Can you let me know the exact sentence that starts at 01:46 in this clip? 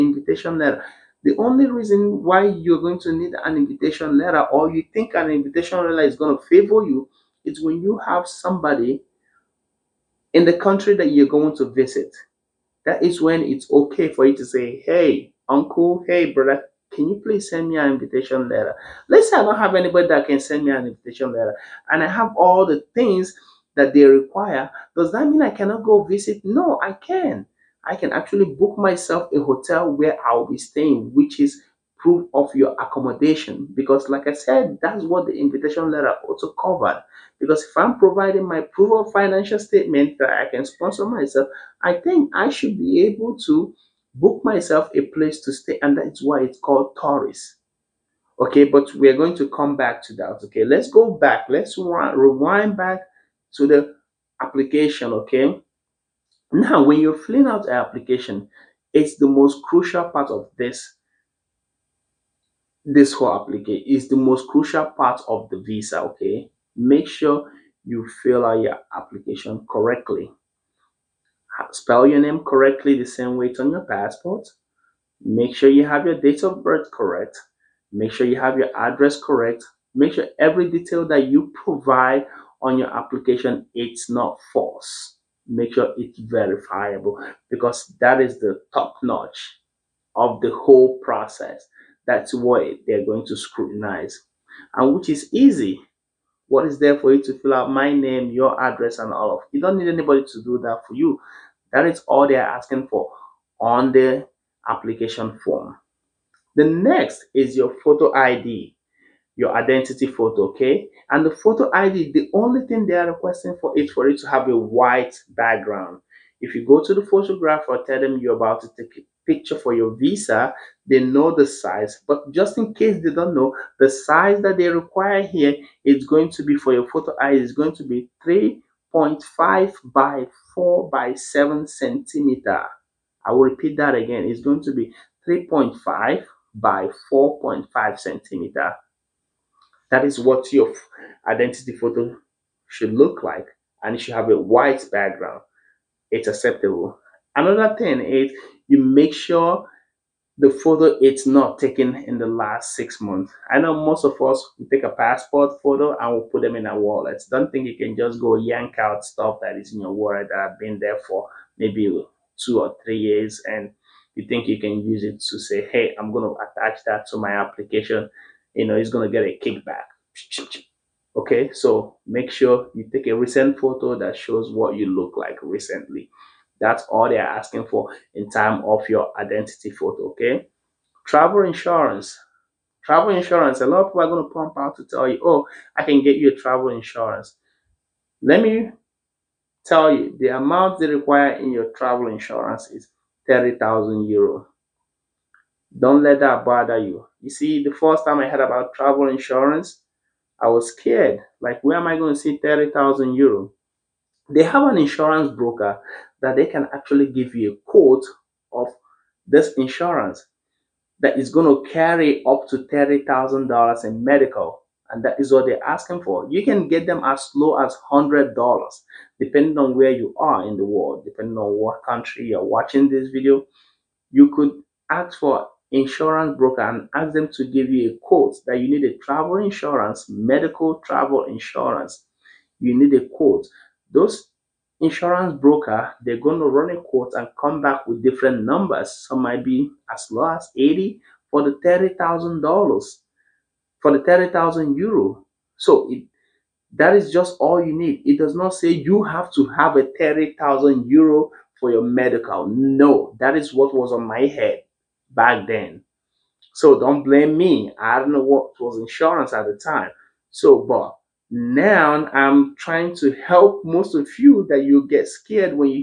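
The next is your photo ID your identity photo, okay?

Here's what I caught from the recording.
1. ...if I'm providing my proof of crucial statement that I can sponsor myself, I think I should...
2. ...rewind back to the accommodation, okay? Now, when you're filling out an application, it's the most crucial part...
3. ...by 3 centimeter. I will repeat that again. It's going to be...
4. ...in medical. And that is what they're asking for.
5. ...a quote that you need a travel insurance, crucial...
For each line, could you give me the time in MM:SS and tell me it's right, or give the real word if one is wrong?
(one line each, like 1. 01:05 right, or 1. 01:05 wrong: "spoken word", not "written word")
1. 00:37 wrong: "financial", not "crucial"
2. 00:51 wrong: "application", not "accommodation"
3. 02:10 wrong: "7", not "3"
4. 03:33 right
5. 03:47 wrong: "medical", not "crucial".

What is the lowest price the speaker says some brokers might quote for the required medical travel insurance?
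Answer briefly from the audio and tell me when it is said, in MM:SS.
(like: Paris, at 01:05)
80, at 03:59.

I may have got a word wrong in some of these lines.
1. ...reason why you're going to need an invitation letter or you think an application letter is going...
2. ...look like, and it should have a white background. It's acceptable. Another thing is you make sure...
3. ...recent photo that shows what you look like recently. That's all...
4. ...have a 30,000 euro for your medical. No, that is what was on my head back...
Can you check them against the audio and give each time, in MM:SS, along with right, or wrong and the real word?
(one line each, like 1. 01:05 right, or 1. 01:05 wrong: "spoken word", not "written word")
1. 00:01 wrong: "invitation", not "application"
2. 02:22 right
3. 02:53 right
4. 04:09 right.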